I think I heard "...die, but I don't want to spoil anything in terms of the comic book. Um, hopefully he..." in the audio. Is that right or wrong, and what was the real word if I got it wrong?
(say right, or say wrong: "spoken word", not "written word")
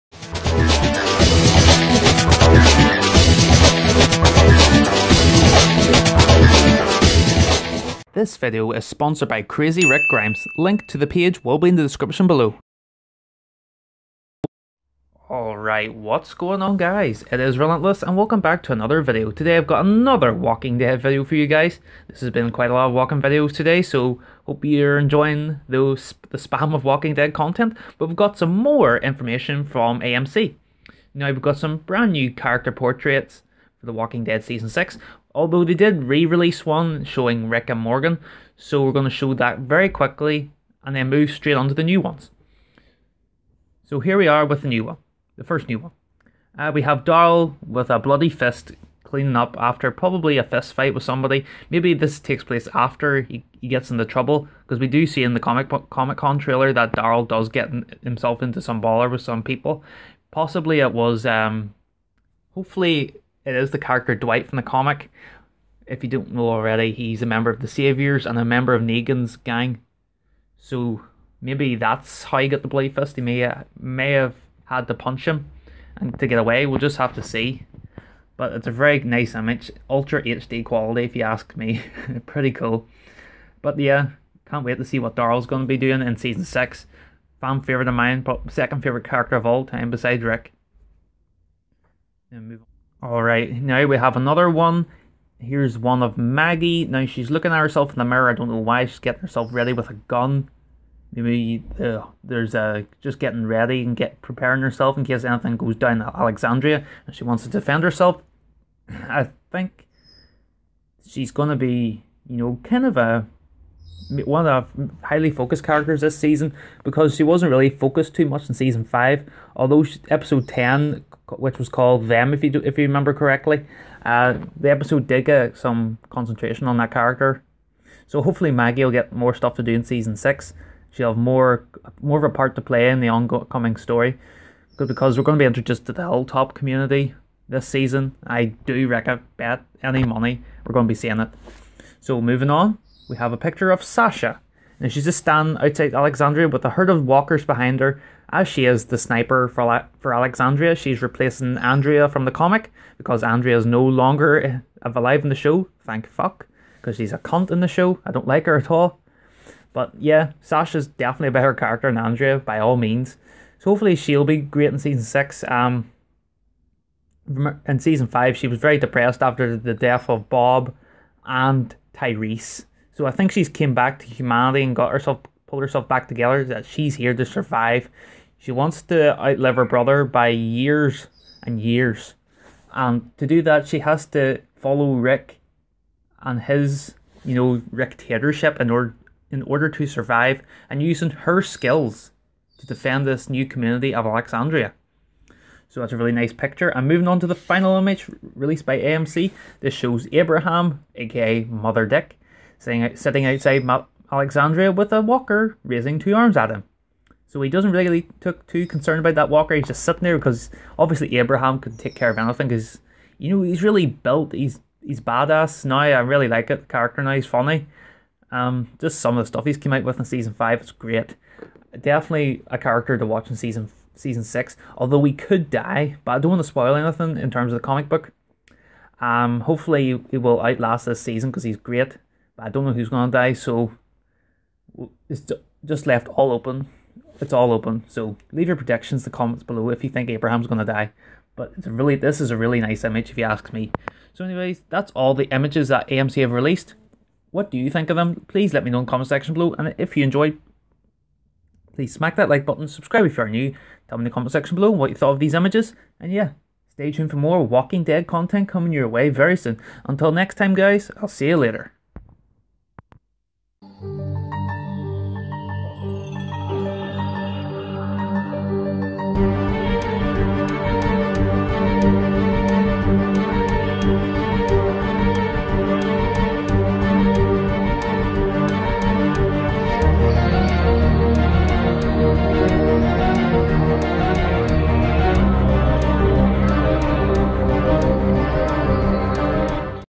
right.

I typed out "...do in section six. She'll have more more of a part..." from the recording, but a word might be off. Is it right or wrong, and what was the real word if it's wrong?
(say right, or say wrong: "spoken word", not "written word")
wrong: "season", not "section".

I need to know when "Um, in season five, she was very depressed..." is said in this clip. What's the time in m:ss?
2:45.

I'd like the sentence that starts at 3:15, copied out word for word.
So that's a really nice picture.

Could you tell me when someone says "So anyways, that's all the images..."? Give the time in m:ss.
4:04.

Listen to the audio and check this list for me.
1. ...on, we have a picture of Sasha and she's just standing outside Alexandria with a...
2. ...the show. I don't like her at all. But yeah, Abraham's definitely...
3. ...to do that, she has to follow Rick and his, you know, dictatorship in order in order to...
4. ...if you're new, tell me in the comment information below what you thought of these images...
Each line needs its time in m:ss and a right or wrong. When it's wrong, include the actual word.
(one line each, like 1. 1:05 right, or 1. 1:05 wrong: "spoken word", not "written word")
1. 2:22 right
2. 2:37 wrong: "Sasha", not "Abraham"
3. 3:03 right
4. 4:13 wrong: "section", not "information".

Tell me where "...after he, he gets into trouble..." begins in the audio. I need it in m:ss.
0:52.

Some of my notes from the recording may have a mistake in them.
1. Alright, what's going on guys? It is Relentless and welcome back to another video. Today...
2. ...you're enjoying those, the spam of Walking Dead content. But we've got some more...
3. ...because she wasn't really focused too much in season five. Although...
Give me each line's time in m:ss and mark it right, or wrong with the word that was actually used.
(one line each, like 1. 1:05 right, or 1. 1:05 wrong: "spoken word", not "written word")
1. 0:15 right
2. 0:24 right
3. 1:56 right.